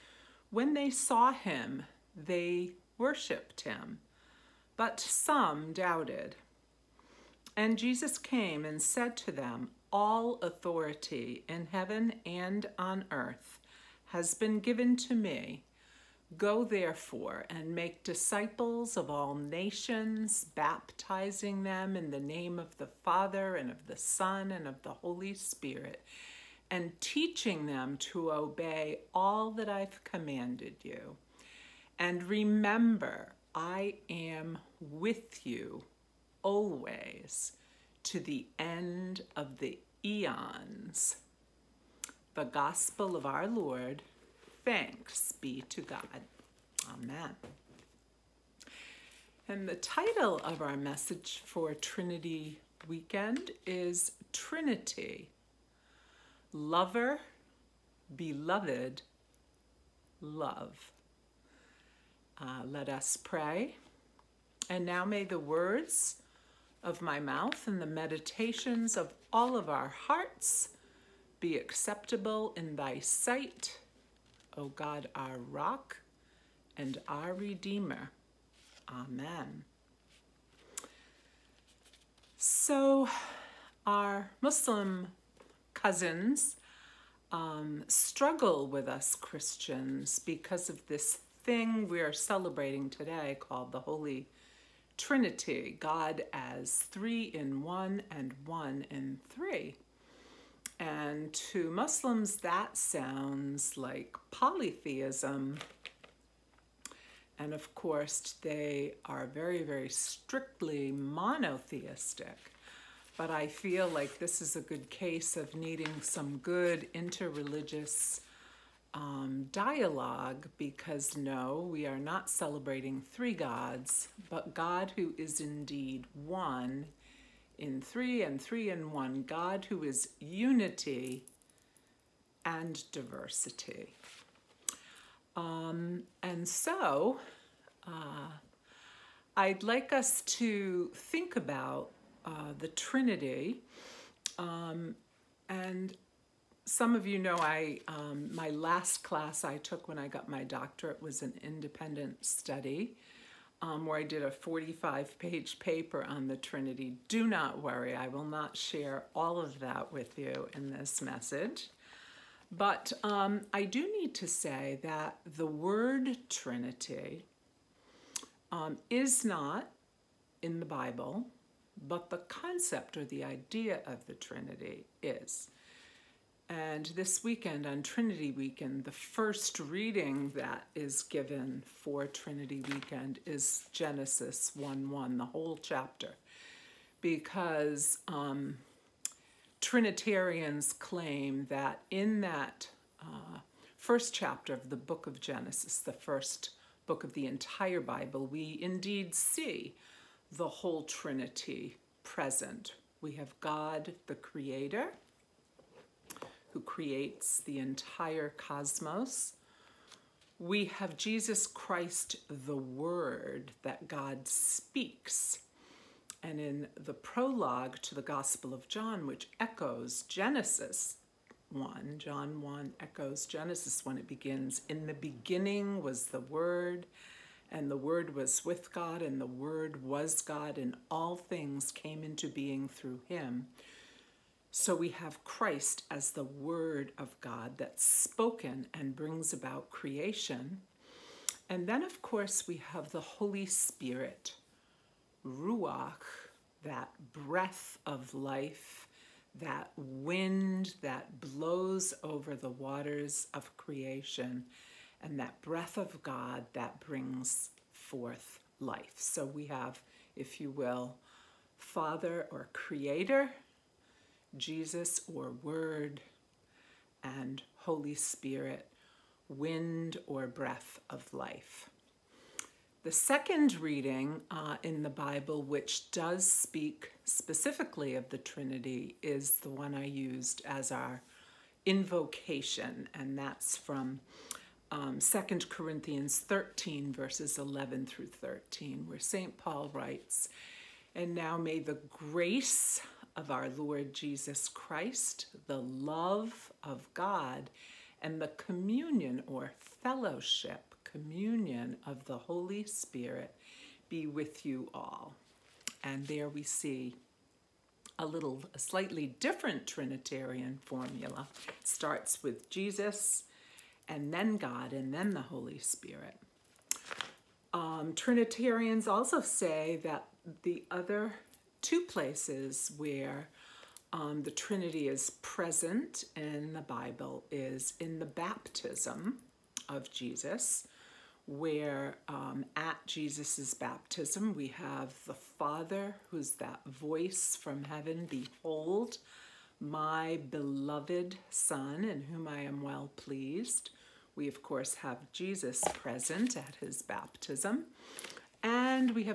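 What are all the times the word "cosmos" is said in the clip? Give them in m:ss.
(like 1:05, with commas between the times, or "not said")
3:28.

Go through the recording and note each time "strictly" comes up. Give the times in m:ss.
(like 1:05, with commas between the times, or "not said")
1:49.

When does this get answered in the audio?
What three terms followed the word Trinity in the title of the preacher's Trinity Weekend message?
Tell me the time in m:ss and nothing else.
0:56.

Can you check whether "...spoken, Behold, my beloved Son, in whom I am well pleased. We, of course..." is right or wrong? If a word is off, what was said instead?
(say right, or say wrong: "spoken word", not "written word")
wrong: "heaven", not "spoken".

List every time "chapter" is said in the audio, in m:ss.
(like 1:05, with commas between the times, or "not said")
3:05, 3:14.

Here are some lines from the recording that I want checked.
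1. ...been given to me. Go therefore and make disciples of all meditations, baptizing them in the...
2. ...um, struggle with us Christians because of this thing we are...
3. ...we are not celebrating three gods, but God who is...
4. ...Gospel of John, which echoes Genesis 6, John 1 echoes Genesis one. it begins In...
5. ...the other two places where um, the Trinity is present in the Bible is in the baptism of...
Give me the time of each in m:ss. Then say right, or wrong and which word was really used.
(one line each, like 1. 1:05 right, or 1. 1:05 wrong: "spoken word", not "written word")
1. 0:14 wrong: "nations", not "meditations"
2. 1:27 right
3. 2:01 right
4. 3:38 wrong: "1", not "6"
5. 5:20 right.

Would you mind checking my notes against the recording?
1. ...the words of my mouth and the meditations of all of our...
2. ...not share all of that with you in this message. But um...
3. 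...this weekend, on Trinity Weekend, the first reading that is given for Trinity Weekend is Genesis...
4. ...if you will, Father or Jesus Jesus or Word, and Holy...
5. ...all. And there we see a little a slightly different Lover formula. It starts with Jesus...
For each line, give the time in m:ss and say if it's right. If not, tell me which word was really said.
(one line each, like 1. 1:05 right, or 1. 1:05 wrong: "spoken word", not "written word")
1. 1:05 right
2. 2:38 right
3. 2:56 right
4. 4:20 wrong: "Creator", not "Jesus"
5. 5:04 wrong: "Trinitarian", not "Lover".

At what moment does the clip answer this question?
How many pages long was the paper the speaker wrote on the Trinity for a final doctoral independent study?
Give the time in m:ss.
2:34.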